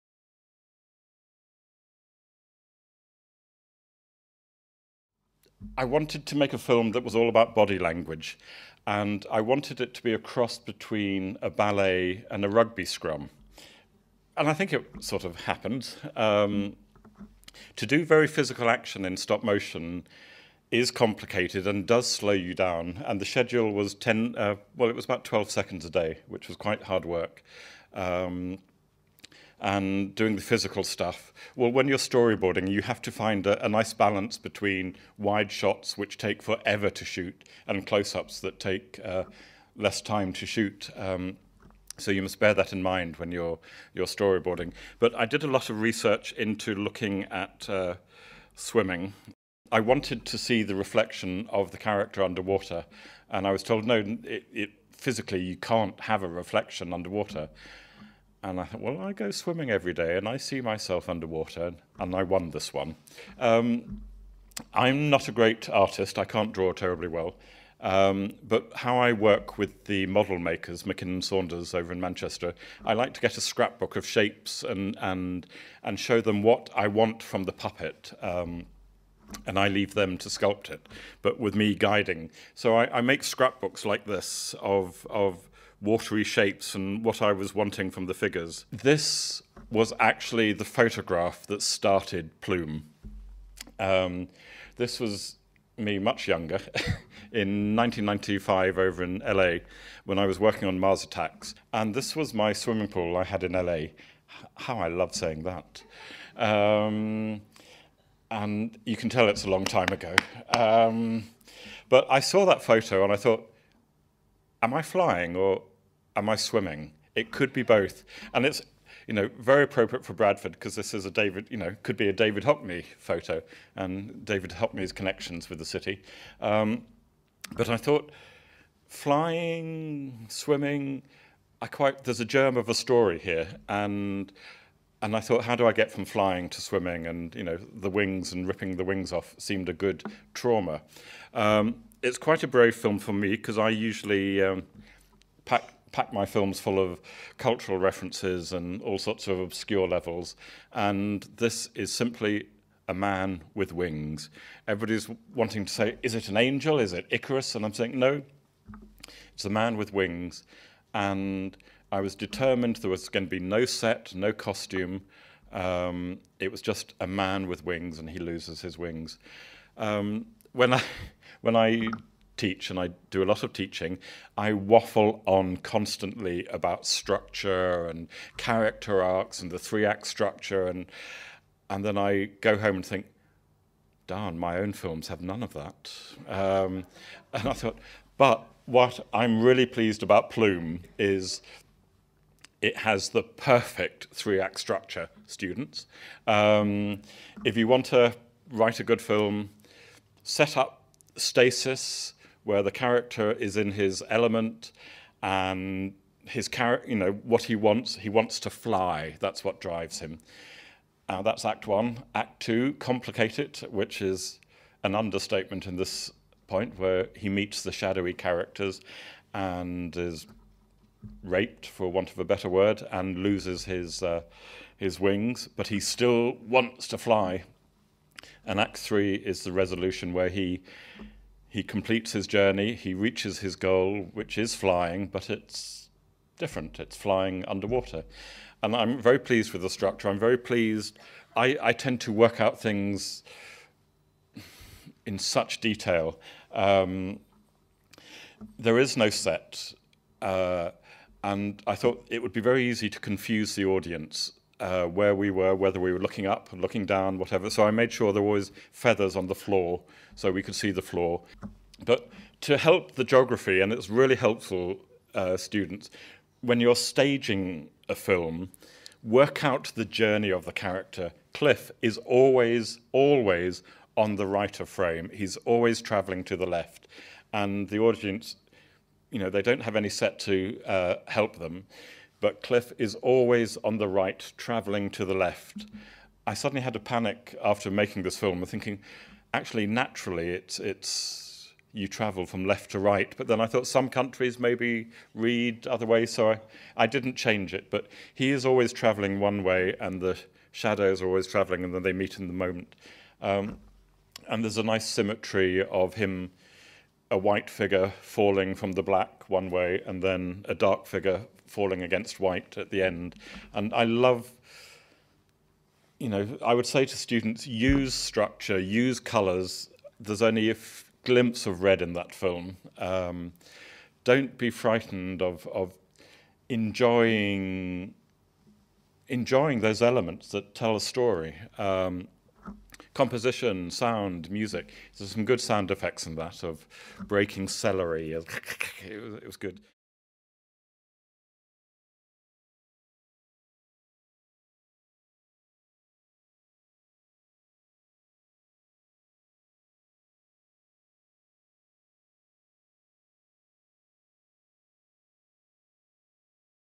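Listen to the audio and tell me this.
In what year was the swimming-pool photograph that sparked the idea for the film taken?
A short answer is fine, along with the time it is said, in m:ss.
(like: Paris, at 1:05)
1995, at 1:37.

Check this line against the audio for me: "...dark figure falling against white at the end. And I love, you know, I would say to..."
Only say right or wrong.
right.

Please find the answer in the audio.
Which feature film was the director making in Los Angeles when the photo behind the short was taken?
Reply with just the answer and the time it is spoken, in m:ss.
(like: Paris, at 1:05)
Mars Attacks, at 1:40.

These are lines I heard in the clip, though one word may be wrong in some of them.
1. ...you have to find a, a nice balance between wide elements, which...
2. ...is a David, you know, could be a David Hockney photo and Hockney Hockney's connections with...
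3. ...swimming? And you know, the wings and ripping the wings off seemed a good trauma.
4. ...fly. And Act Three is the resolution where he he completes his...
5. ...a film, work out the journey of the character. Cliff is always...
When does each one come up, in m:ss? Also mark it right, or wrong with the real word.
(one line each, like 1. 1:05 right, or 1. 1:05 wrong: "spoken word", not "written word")
1. 0:32 wrong: "shots", not "elements"
2. 2:00 wrong: "David", not "Hockney"
3. 2:16 right
4. 3:46 right
5. 4:27 right.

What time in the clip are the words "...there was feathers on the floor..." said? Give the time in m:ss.
4:18.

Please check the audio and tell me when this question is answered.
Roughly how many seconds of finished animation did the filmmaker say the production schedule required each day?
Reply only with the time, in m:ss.
0:25.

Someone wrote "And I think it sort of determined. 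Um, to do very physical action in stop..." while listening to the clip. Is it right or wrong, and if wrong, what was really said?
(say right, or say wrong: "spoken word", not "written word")
wrong: "happened", not "determined".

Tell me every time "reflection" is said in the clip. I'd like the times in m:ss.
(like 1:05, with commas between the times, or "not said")
0:50, 0:56.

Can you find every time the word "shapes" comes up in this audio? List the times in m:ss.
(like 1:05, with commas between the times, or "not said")
1:14, 1:26.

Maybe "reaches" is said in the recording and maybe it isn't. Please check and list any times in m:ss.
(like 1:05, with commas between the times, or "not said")
3:52.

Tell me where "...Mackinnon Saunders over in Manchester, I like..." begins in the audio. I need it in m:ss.
1:10.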